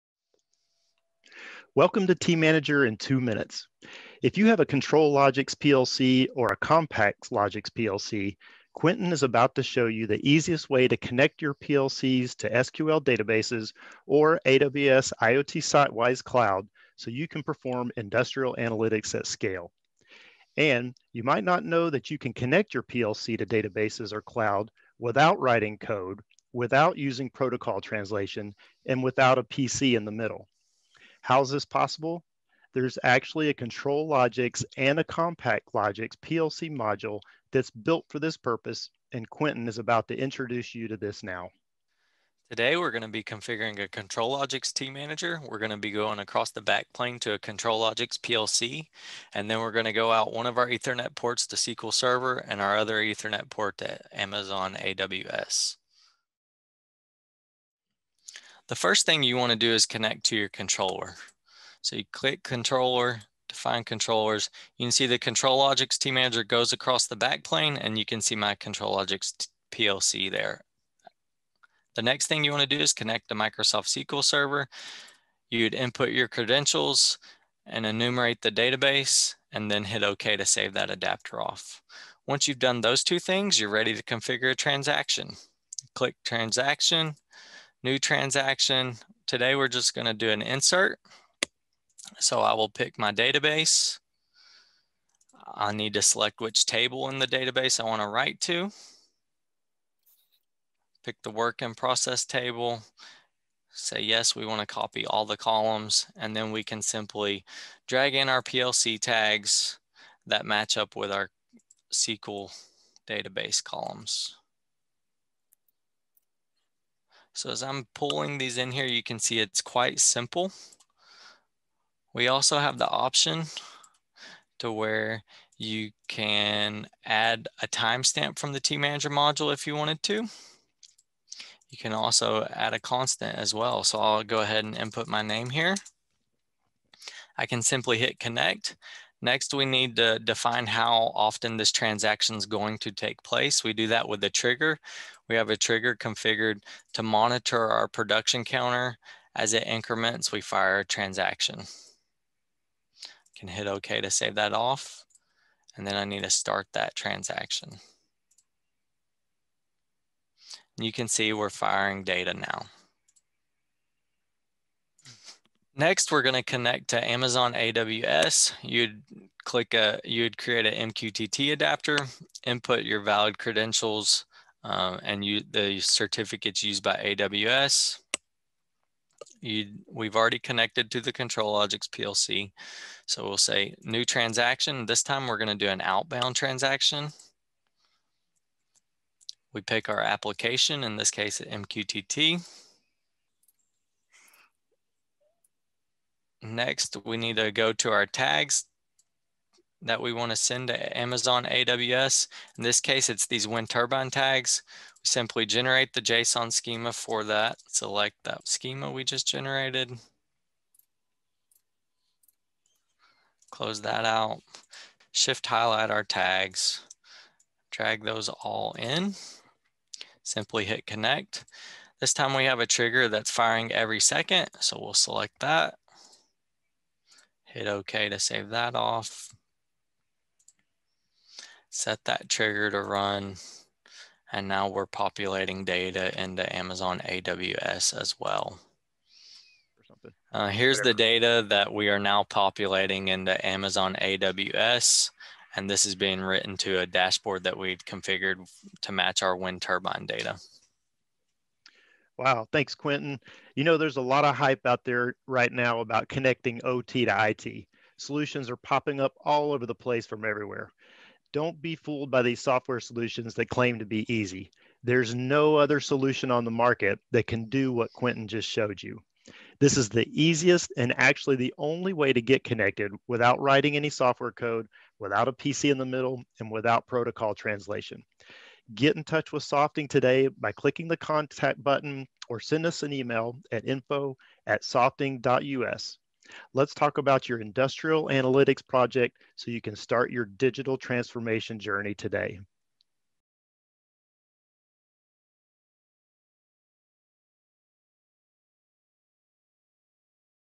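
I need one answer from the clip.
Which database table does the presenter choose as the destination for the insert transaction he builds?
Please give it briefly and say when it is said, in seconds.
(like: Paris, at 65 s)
work in process, at 101 s.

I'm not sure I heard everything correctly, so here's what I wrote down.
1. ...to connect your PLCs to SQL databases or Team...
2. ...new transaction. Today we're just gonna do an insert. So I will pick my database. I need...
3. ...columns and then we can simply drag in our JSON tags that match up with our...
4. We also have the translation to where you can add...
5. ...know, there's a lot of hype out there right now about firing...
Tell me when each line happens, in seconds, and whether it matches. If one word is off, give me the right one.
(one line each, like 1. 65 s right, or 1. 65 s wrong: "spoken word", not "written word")
1. 10 s wrong: "AWS", not "Team"
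2. 87 s right
3. 105 s wrong: "PLC", not "JSON"
4. 122 s wrong: "option", not "translation"
5. 253 s wrong: "connecting", not "firing".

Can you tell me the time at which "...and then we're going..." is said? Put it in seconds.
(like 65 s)
49 s.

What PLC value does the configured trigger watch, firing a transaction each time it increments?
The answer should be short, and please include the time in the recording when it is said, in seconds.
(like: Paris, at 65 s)
production counter, at 147 s.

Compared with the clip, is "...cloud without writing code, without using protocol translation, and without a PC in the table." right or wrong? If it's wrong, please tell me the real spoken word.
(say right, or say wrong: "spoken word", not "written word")
wrong: "middle", not "table".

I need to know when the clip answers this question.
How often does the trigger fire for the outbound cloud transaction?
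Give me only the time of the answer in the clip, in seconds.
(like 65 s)
223 s.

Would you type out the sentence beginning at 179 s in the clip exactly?
You, we've already connected to the ControlLogix PLC.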